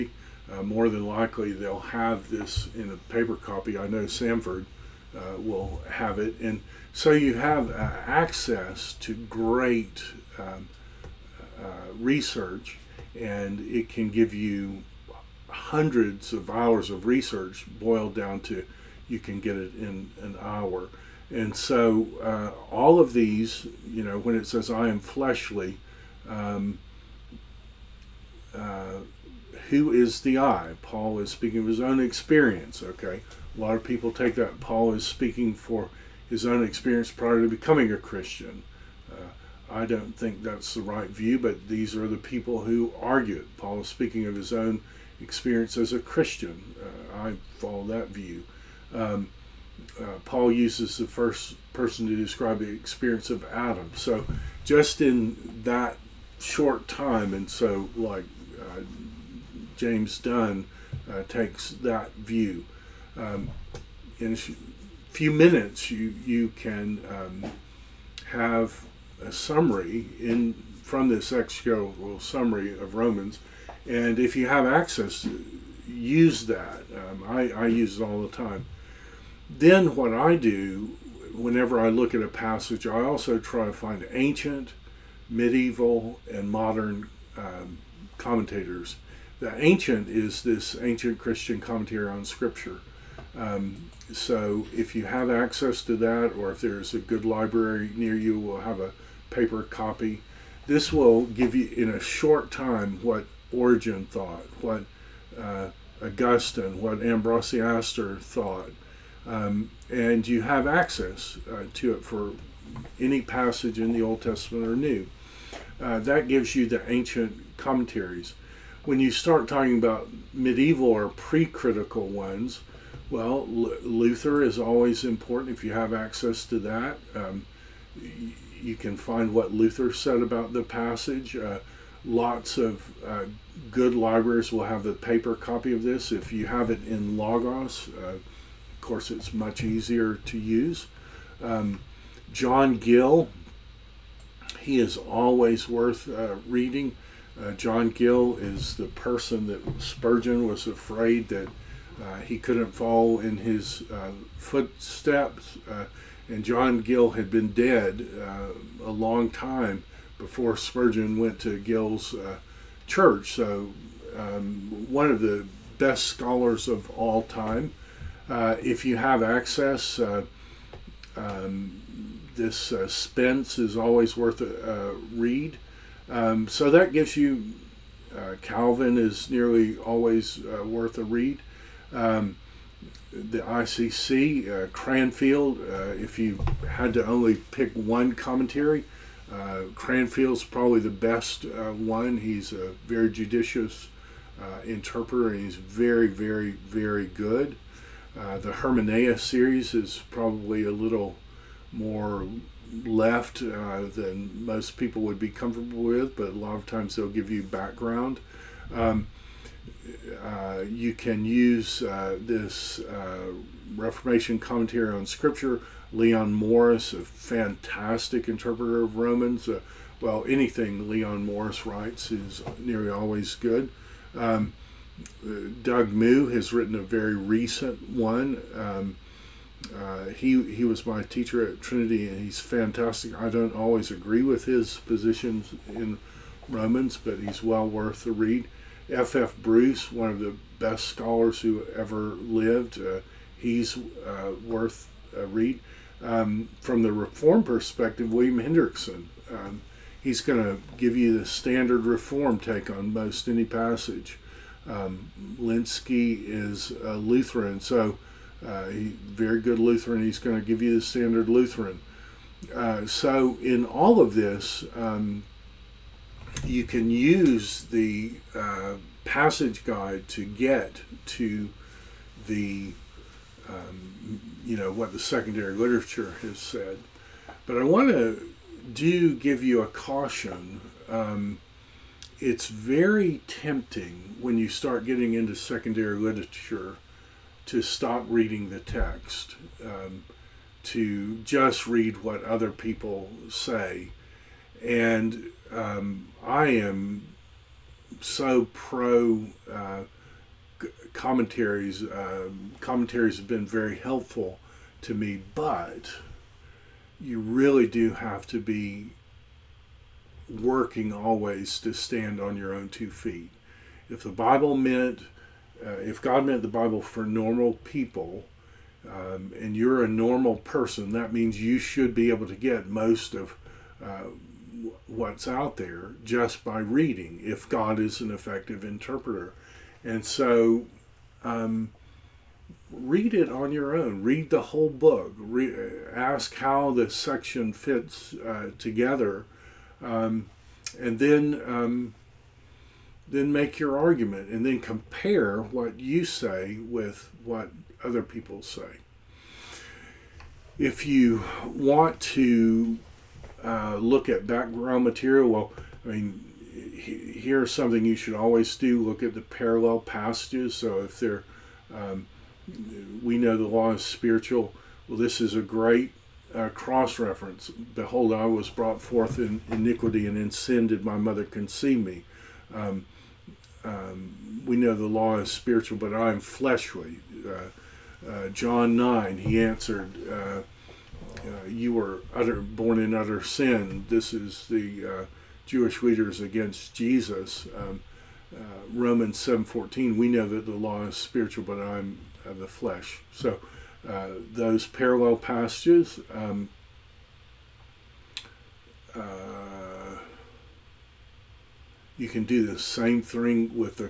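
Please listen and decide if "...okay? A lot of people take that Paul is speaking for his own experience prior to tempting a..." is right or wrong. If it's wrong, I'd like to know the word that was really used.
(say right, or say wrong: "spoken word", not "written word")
wrong: "becoming", not "tempting".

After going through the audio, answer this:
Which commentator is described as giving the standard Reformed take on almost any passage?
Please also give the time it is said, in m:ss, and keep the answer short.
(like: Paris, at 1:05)
William Hendriksen, at 4:08.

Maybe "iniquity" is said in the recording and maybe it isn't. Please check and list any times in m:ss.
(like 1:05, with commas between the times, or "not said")
6:09.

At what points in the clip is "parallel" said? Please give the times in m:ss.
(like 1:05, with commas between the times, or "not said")
5:59, 6:34.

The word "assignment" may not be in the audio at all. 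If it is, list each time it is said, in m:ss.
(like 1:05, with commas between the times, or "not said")
not said.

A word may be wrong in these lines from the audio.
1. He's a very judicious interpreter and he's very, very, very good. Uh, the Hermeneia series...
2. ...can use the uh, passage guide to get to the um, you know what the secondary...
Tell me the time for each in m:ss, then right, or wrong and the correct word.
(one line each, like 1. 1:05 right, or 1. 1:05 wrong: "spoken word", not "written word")
1. 3:12 right
2. 4:26 right.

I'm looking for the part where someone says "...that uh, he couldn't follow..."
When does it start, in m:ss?
2:31.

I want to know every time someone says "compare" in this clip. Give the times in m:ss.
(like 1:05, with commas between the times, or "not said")
5:44.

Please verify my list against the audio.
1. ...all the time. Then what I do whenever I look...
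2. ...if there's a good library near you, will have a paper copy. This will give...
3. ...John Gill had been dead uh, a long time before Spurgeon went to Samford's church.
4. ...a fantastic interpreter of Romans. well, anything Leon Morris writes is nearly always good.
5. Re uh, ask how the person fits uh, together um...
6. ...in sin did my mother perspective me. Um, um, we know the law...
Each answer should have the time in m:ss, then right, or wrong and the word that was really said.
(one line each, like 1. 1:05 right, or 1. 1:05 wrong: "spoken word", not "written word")
1. 1:18 right
2. 1:36 right
3. 2:36 wrong: "Gill", not "Samford"
4. 3:36 right
5. 5:35 wrong: "section", not "person"
6. 6:10 wrong: "conceive", not "perspective".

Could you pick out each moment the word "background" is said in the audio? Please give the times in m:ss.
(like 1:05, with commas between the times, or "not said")
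3:27, 5:54.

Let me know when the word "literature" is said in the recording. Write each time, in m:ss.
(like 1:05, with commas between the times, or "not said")
4:35, 4:45.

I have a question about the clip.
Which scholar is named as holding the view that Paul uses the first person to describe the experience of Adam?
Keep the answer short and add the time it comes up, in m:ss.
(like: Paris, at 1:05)
James Dunn, at 0:59.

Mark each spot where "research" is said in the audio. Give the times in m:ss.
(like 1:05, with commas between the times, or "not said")
0:11, 0:17.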